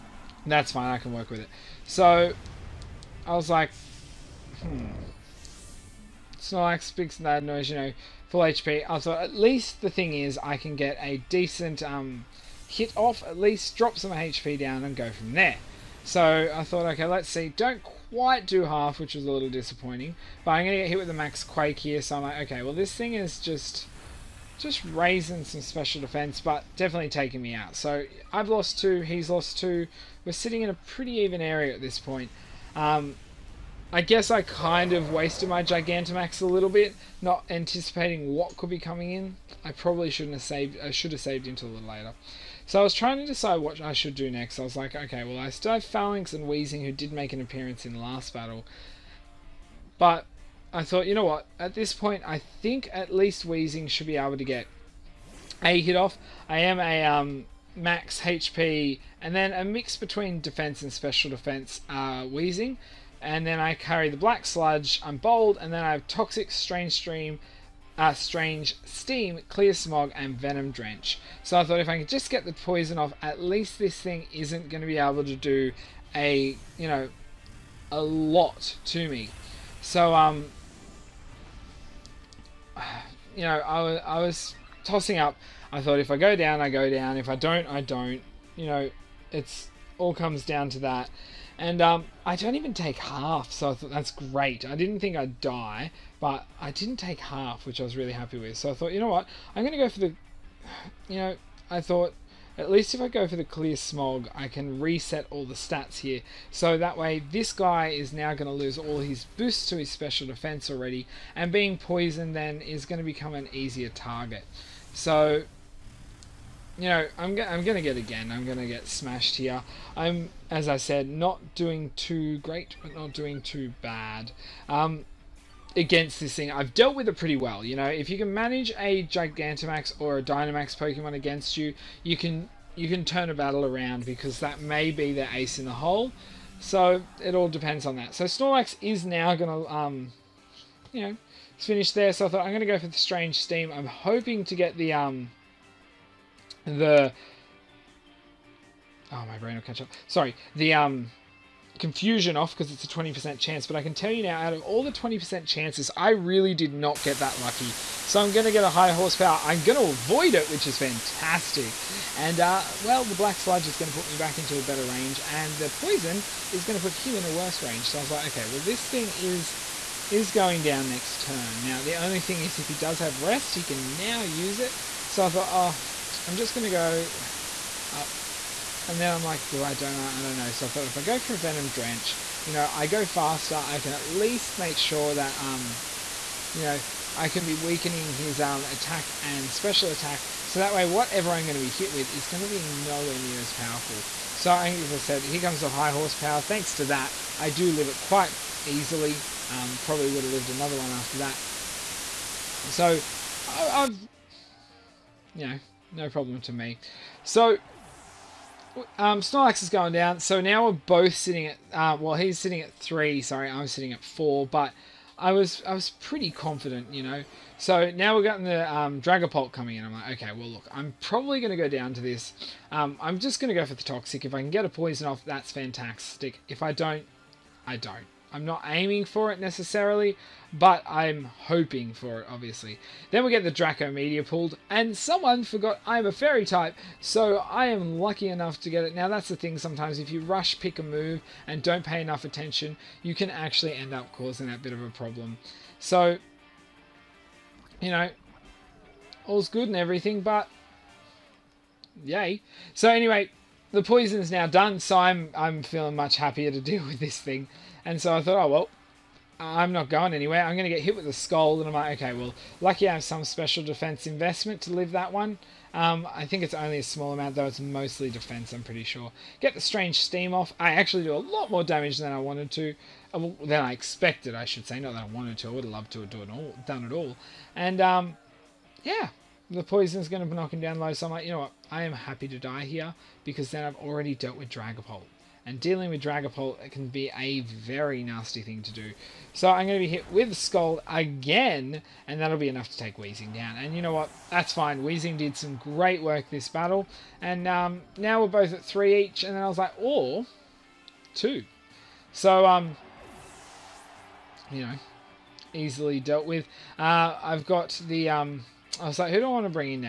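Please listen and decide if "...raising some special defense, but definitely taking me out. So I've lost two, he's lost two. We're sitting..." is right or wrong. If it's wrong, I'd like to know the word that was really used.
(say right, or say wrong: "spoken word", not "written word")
right.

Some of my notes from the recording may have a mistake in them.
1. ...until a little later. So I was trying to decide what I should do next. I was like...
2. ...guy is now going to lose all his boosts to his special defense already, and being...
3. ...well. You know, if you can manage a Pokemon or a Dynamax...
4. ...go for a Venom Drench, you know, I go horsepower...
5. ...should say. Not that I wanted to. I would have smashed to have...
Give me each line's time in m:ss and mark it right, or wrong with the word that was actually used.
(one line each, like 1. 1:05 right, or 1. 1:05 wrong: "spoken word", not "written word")
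1. 0:41 right
2. 1:47 right
3. 2:07 wrong: "Gigantamax", not "Pokemon"
4. 3:01 wrong: "faster", not "horsepower"
5. 4:34 wrong: "loved", not "smashed".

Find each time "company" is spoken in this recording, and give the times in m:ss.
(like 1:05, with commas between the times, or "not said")
not said.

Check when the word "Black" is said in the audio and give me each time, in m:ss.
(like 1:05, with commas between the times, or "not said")
1:04, 2:43.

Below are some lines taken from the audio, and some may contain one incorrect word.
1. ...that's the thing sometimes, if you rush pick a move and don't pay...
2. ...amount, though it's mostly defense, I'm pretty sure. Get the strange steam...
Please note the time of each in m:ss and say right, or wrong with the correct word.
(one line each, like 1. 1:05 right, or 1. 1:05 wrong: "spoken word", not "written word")
1. 3:59 right
2. 4:27 right.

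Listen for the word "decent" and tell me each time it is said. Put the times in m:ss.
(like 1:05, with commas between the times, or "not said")
0:11.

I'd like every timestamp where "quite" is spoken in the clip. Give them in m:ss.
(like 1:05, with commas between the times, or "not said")
0:18, 3:18.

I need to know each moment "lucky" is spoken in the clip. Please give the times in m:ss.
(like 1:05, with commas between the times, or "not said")
2:37, 3:58, 4:22.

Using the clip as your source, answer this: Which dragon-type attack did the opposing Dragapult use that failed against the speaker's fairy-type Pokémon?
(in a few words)
Draco Meteor.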